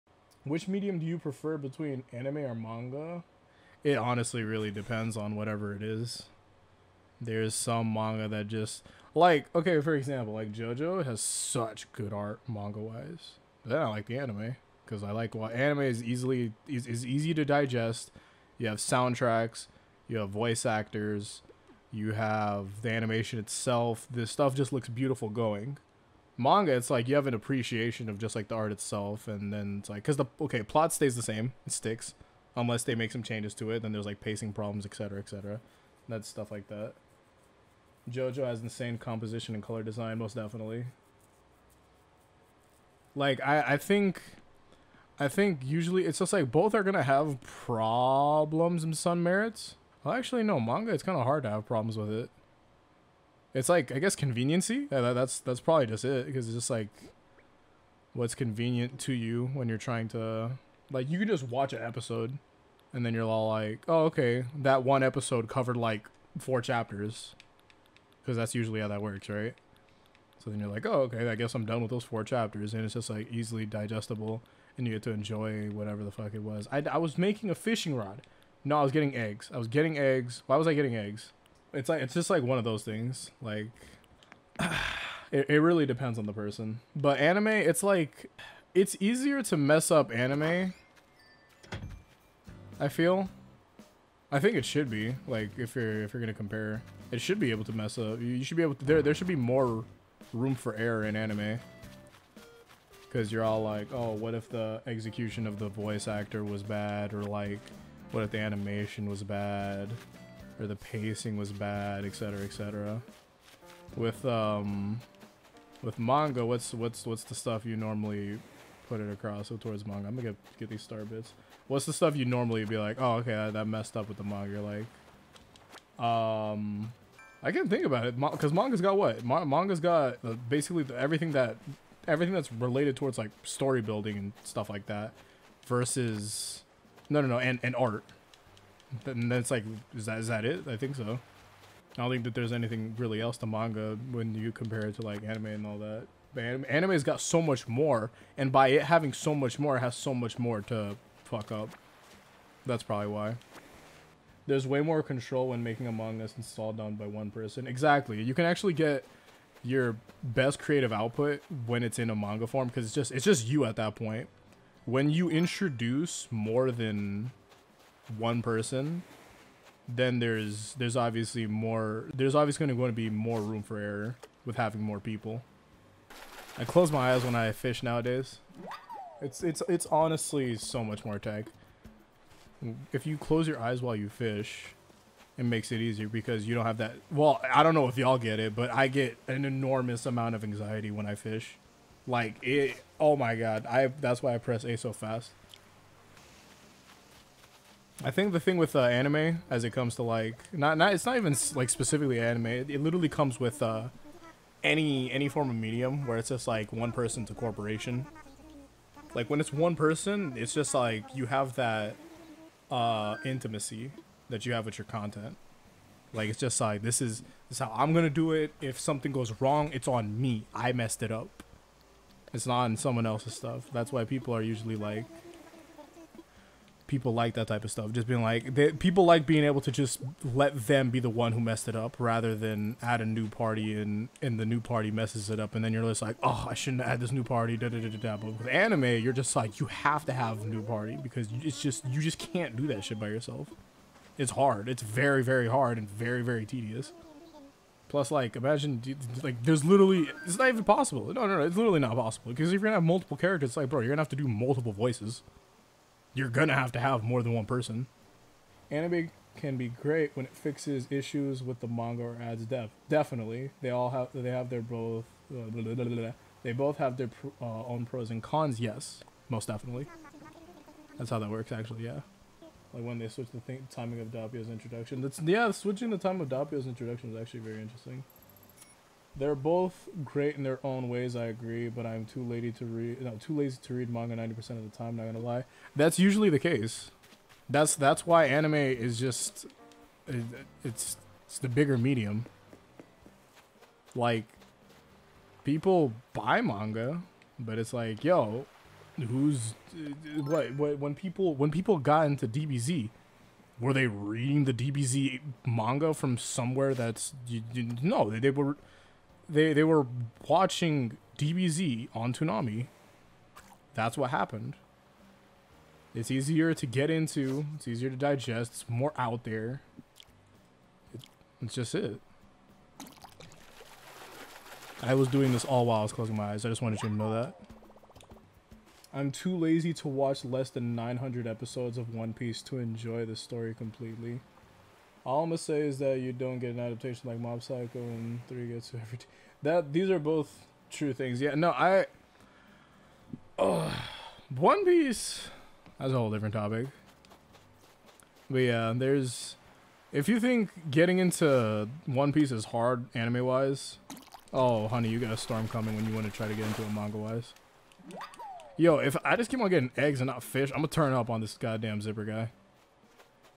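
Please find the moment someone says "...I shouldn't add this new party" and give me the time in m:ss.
3:56.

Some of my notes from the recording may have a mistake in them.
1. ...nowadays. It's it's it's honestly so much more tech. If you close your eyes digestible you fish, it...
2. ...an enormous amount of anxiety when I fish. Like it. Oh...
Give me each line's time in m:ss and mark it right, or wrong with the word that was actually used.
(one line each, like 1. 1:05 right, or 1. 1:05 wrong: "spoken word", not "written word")
1. 2:57 wrong: "while", not "digestible"
2. 3:09 right.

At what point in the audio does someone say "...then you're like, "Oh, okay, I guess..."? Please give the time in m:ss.
1:10.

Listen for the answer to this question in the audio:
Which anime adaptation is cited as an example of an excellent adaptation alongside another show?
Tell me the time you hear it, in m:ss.
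5:37.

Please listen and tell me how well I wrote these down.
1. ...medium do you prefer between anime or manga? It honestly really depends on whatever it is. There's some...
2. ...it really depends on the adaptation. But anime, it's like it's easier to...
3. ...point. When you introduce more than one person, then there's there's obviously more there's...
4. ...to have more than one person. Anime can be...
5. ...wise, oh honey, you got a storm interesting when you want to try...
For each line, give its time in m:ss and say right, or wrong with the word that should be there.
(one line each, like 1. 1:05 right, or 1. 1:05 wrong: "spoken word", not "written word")
1. 0:00 right
2. 1:25 wrong: "person", not "adaptation"
3. 2:43 right
4. 4:16 right
5. 5:53 wrong: "coming", not "interesting".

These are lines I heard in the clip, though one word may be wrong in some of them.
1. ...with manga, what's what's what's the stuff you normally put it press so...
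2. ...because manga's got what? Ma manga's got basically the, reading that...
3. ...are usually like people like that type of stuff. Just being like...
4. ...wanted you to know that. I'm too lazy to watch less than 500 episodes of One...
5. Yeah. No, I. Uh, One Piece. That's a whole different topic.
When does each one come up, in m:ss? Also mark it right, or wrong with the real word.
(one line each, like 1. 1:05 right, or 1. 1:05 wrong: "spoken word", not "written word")
1. 1:55 wrong: "across", not "press"
2. 2:08 wrong: "everything", not "reading"
3. 3:44 right
4. 5:26 wrong: "900", not "500"
5. 5:41 right.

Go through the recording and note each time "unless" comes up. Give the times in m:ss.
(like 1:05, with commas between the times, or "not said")
0:32.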